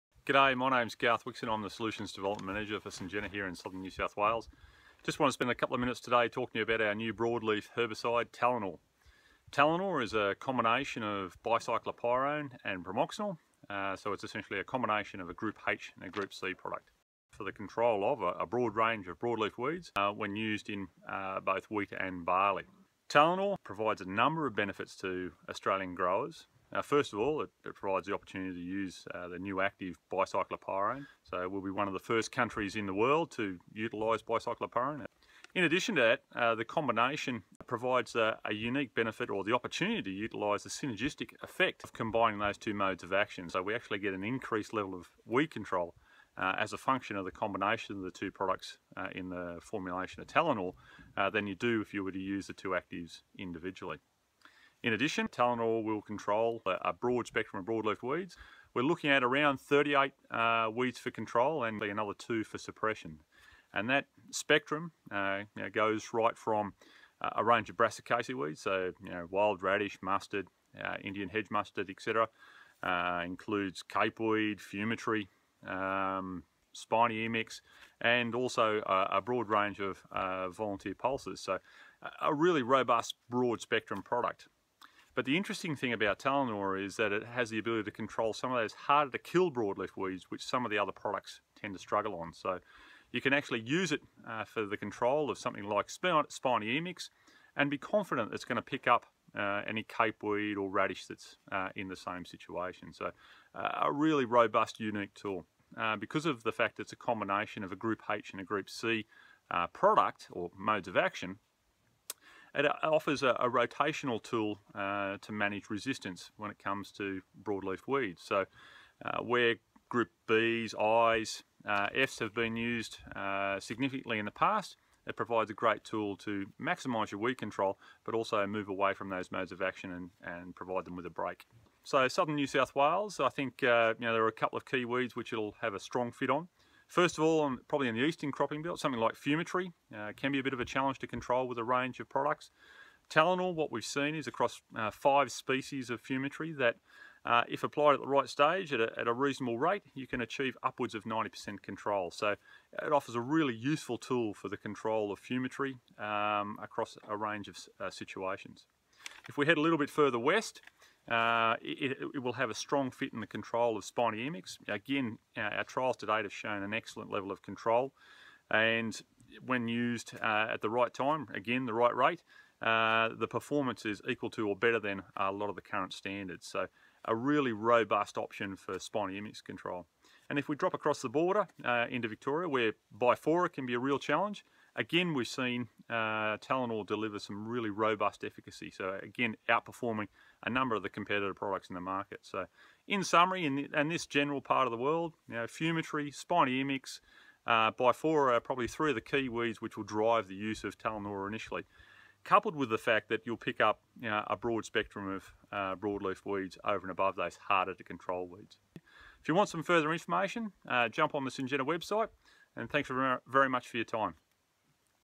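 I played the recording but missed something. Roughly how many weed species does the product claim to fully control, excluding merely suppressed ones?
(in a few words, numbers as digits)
38.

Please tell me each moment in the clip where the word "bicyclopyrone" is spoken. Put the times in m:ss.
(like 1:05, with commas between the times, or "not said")
0:11, 0:30, 0:34.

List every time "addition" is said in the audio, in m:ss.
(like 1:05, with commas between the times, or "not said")
0:35, 0:54.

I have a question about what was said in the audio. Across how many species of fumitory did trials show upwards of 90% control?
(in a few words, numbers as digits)
5.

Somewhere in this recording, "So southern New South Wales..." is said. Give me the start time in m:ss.
2:11.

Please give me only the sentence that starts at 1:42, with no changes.
So uh, a really robust, unique tool.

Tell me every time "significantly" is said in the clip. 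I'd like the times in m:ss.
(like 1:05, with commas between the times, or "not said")
2:03.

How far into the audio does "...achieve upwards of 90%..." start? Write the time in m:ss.
2:30.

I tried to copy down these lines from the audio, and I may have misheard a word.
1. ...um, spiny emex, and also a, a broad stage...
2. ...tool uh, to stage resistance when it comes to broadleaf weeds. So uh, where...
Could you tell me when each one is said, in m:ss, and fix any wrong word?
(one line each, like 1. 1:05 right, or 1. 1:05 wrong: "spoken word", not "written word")
1. 1:15 wrong: "range", not "stage"
2. 1:54 wrong: "manage", not "stage".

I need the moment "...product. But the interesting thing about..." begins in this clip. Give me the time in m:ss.
1:24.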